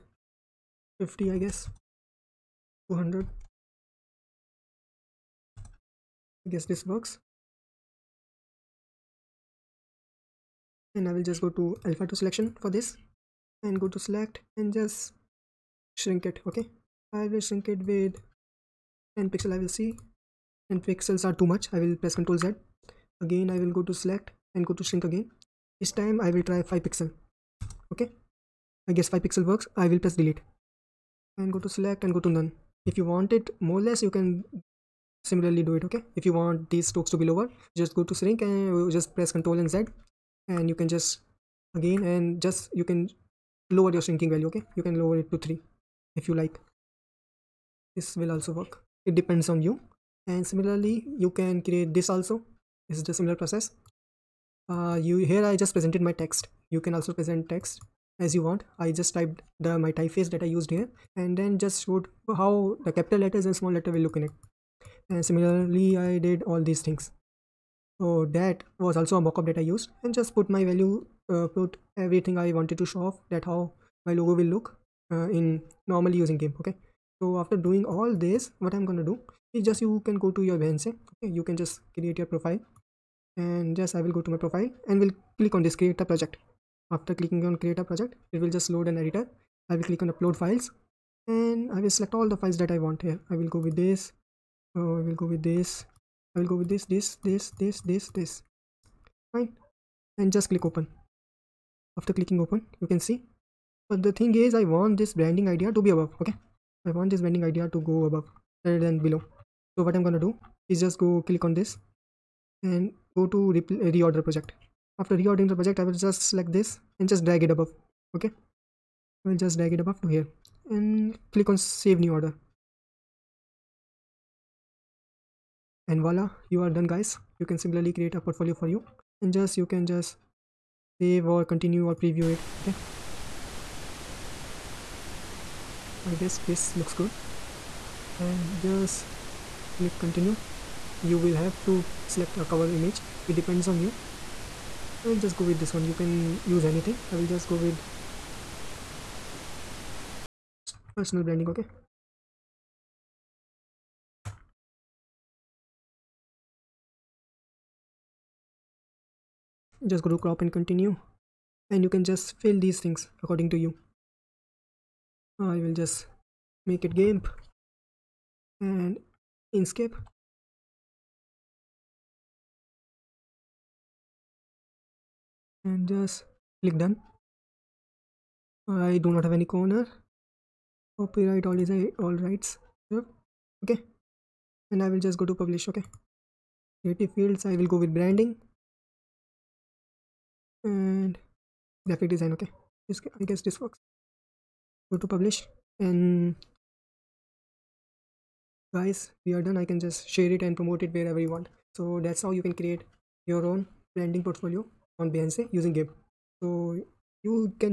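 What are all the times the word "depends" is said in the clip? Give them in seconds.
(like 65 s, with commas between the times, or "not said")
49 s, 143 s.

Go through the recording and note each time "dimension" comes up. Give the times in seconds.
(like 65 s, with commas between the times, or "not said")
not said.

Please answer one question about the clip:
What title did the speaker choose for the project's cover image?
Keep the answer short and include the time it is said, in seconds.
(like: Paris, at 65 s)
Personal branding, at 150 s.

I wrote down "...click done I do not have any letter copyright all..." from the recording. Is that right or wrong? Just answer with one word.
wrong.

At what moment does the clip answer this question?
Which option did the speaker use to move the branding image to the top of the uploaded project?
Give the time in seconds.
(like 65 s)
113 s.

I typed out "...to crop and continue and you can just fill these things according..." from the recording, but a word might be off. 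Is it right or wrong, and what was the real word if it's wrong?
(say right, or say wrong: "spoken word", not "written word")
right.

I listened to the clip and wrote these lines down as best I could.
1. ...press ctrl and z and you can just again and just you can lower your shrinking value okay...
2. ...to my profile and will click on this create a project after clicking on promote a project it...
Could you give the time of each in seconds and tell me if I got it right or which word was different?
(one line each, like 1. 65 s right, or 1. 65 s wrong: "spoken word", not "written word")
1. 39 s right
2. 84 s wrong: "create", not "promote".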